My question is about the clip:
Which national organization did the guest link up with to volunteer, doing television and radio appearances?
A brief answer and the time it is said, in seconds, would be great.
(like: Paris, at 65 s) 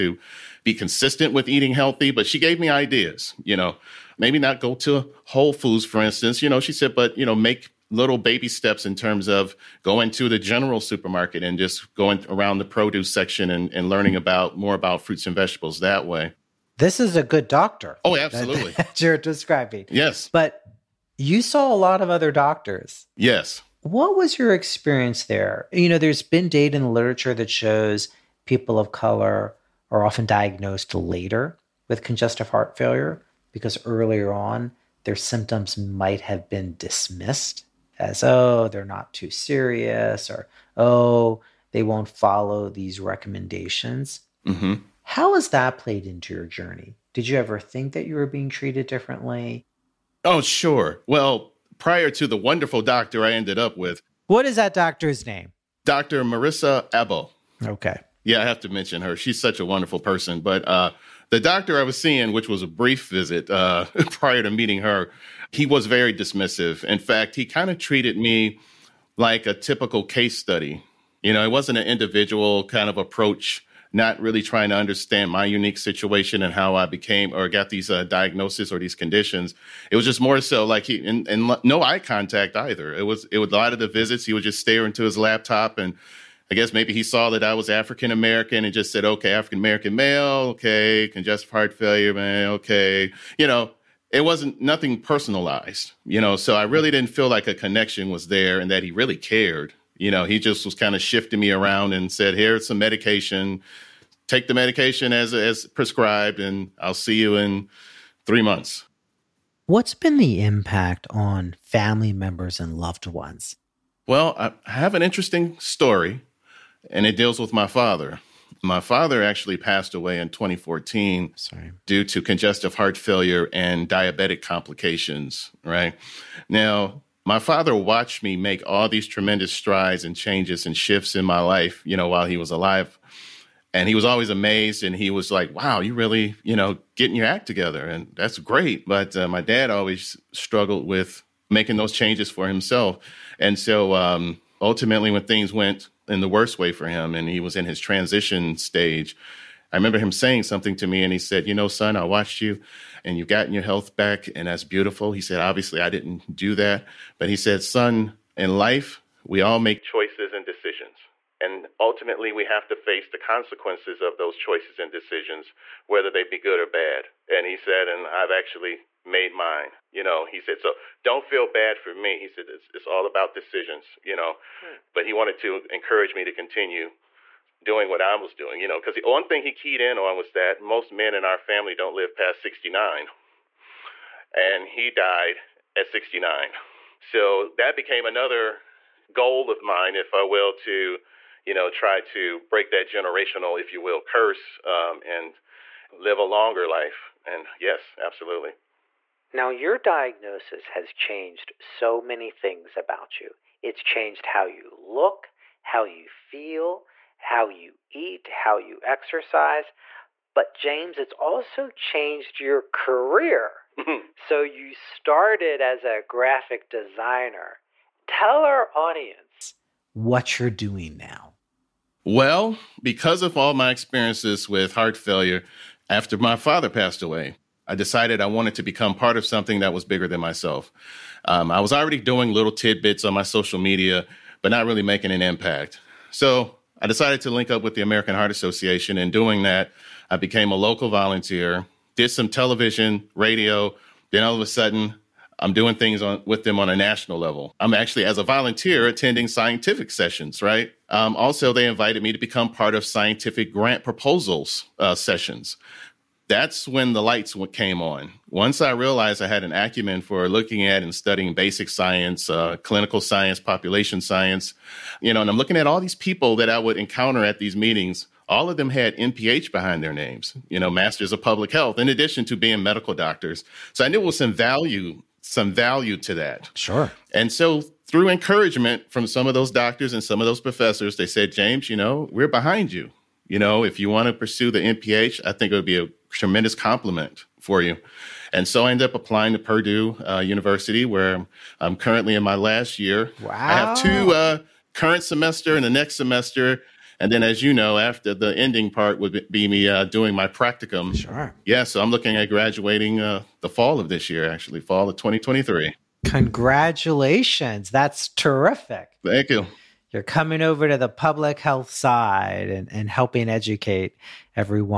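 American Heart Association, at 237 s.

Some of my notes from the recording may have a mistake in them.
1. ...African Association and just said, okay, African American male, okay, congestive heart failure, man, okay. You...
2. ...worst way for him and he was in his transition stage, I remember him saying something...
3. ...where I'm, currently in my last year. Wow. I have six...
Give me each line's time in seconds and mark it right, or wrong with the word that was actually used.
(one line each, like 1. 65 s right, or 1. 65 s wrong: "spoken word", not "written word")
1. 87 s wrong: "American", not "Association"
2. 146 s right
3. 290 s wrong: "two", not "six".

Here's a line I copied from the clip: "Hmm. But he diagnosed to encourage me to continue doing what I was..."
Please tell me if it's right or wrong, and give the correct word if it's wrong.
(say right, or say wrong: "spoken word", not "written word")
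wrong: "wanted", not "diagnosed".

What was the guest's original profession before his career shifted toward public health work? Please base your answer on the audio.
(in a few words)
Graphic designer.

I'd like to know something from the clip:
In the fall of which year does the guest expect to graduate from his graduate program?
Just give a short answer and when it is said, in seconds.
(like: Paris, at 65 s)
2023, at 304 s.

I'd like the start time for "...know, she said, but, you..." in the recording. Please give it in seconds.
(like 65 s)
6 s.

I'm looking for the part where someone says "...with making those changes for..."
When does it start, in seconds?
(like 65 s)
140 s.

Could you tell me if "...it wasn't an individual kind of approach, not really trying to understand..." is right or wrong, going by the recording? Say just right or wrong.
right.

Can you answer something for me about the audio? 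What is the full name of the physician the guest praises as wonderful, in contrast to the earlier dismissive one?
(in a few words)
Marissa Ebo.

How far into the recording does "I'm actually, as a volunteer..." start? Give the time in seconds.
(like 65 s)
247 s.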